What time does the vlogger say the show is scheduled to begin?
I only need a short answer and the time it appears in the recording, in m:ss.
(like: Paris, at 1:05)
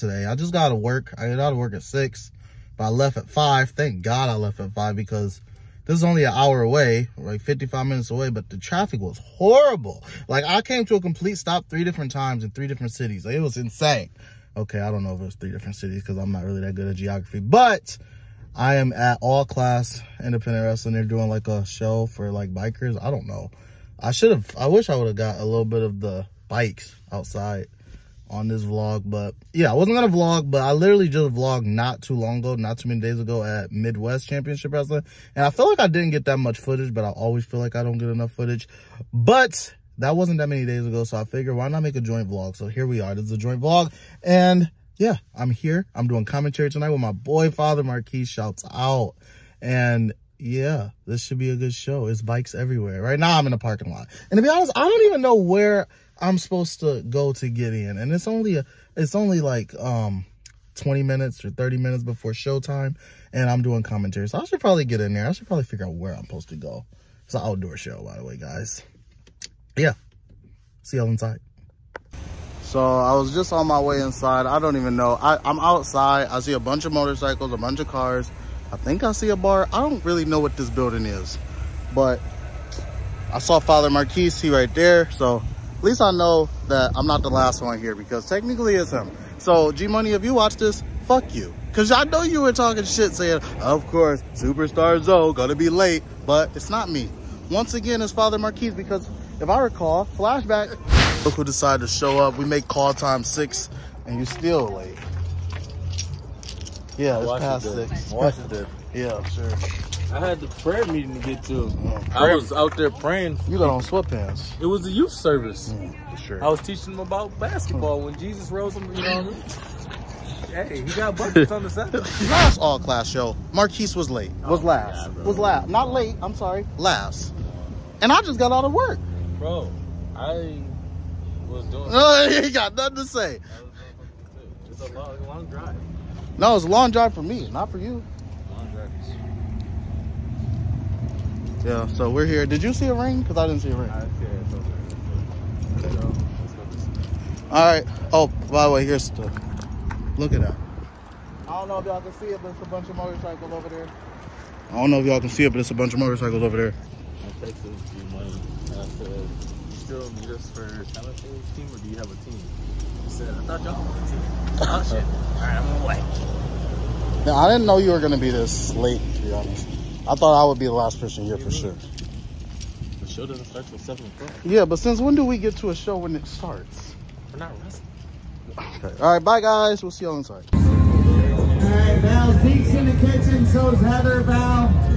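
7 o'clock, at 2:53.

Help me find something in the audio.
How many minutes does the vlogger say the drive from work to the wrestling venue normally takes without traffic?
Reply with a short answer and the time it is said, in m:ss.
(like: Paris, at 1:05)
55 minutes, at 0:07.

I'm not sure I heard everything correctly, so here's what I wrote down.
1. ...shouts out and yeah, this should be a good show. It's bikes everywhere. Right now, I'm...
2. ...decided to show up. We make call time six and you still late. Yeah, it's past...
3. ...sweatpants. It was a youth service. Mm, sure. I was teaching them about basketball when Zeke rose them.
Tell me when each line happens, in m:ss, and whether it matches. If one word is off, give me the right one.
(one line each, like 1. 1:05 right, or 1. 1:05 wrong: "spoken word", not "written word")
1. 0:48 right
2. 1:41 right
3. 1:53 wrong: "Jesus", not "Zeke".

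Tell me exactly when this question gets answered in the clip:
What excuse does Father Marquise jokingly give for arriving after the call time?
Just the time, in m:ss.
1:50.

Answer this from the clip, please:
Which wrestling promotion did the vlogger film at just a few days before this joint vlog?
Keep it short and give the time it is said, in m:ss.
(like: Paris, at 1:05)
Midwest Championship Wrestling, at 0:33.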